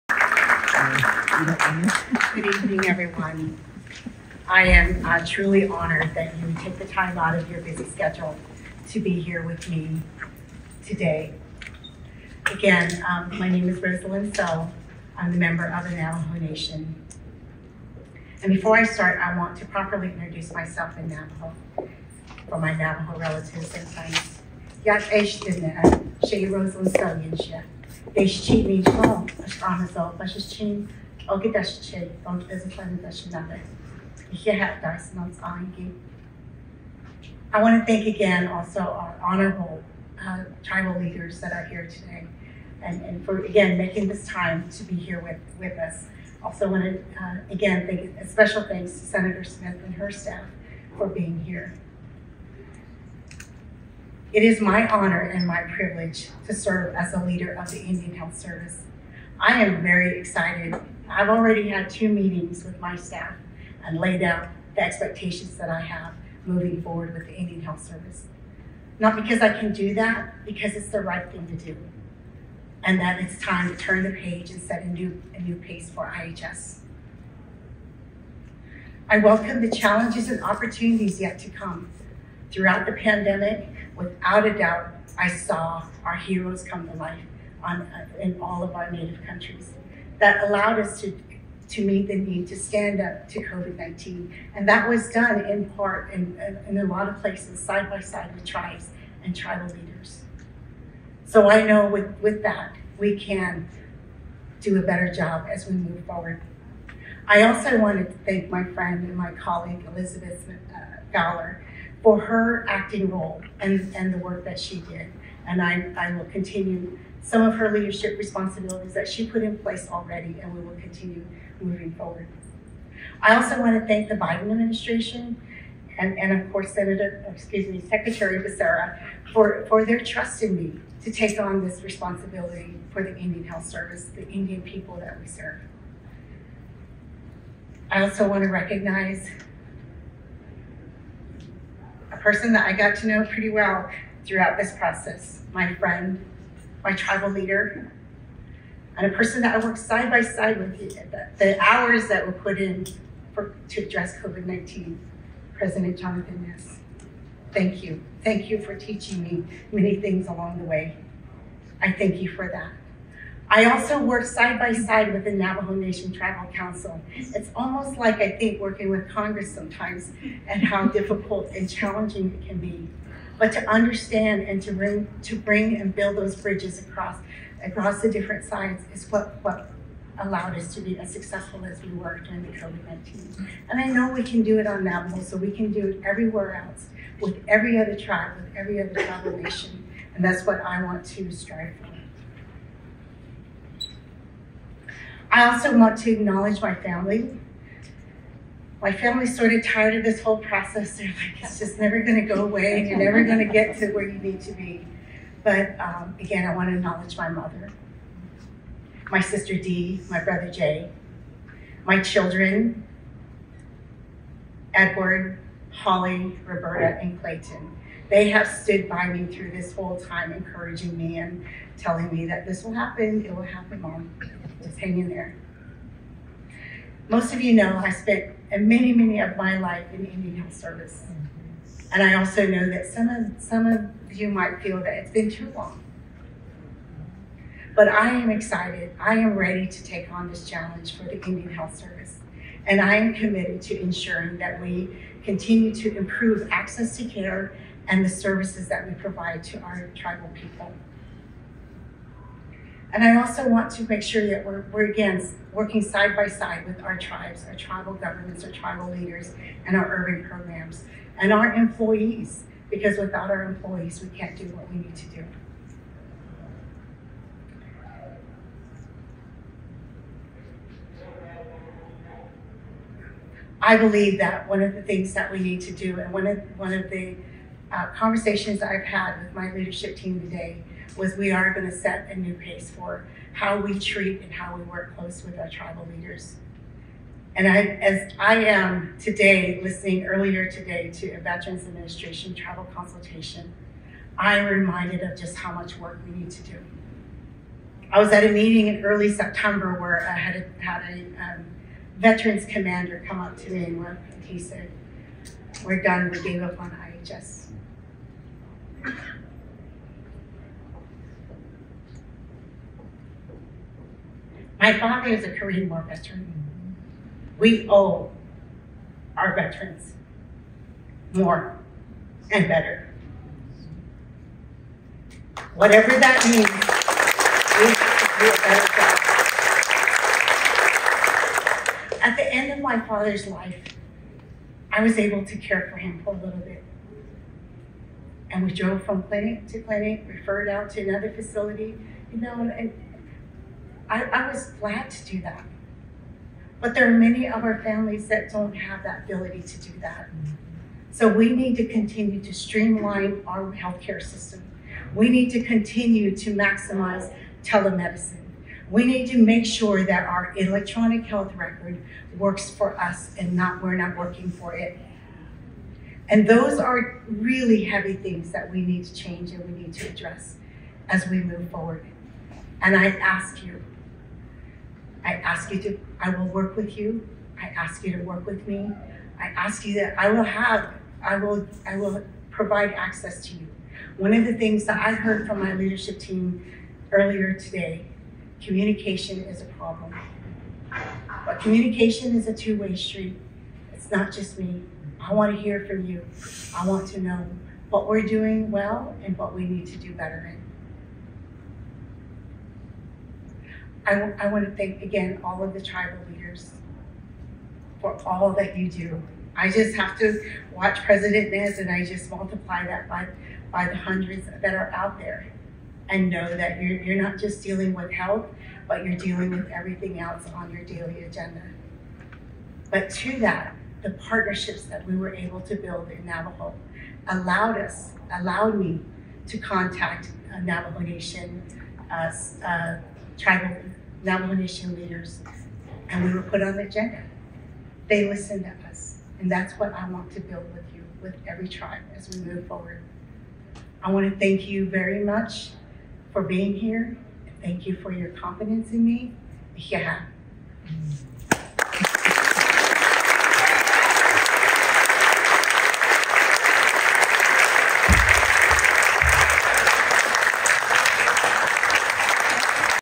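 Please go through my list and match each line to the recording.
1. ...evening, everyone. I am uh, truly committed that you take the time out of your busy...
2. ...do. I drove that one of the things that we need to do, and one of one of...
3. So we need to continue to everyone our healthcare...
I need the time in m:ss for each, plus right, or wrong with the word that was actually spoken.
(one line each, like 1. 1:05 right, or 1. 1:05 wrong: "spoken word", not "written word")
1. 0:02 wrong: "honored", not "committed"
2. 4:25 wrong: "believe", not "drove"
3. 5:50 wrong: "streamline", not "everyone".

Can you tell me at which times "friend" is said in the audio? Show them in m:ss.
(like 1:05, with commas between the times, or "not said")
0:23, 1:48, 2:25.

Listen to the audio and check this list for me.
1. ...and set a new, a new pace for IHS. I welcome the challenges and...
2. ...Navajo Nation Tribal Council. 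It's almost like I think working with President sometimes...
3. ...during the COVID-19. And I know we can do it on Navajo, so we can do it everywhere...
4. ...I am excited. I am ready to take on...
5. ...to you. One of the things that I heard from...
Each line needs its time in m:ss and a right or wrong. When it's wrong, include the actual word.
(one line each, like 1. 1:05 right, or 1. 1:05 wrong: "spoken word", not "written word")
1. 1:14 right
2. 2:45 wrong: "Congress", not "President"
3. 3:02 right
4. 3:57 right
5. 6:23 right.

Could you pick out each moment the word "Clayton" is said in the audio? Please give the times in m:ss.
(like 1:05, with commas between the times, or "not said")
3:37.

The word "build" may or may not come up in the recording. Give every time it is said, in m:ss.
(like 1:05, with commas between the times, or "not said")
2:55, 7:05, 7:20.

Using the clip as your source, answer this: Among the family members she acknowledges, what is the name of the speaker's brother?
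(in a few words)
Jay.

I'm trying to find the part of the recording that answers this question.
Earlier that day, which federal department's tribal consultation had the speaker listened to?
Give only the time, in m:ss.
4:51.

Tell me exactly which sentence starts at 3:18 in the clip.
My family's sort of tired of this whole process.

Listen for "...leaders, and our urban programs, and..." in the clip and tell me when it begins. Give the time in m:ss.
4:18.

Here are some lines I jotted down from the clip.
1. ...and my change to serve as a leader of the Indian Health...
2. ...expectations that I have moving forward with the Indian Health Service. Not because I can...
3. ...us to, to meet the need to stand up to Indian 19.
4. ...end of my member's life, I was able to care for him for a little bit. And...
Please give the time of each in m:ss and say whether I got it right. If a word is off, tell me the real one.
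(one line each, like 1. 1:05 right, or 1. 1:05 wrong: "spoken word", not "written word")
1. 0:55 wrong: "privilege", not "change"
2. 1:04 right
3. 1:30 wrong: "COVID", not "Indian"
4. 5:32 wrong: "father", not "member".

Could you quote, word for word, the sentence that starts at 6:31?
But communication is a two-way street.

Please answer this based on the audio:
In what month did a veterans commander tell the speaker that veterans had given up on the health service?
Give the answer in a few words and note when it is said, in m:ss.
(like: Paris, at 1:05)
September, at 4:59.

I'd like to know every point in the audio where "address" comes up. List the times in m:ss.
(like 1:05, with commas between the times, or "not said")
2:33, 6:09.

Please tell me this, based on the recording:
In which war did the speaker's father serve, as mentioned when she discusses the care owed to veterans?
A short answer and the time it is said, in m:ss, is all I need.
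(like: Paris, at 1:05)
Korean War, at 5:15.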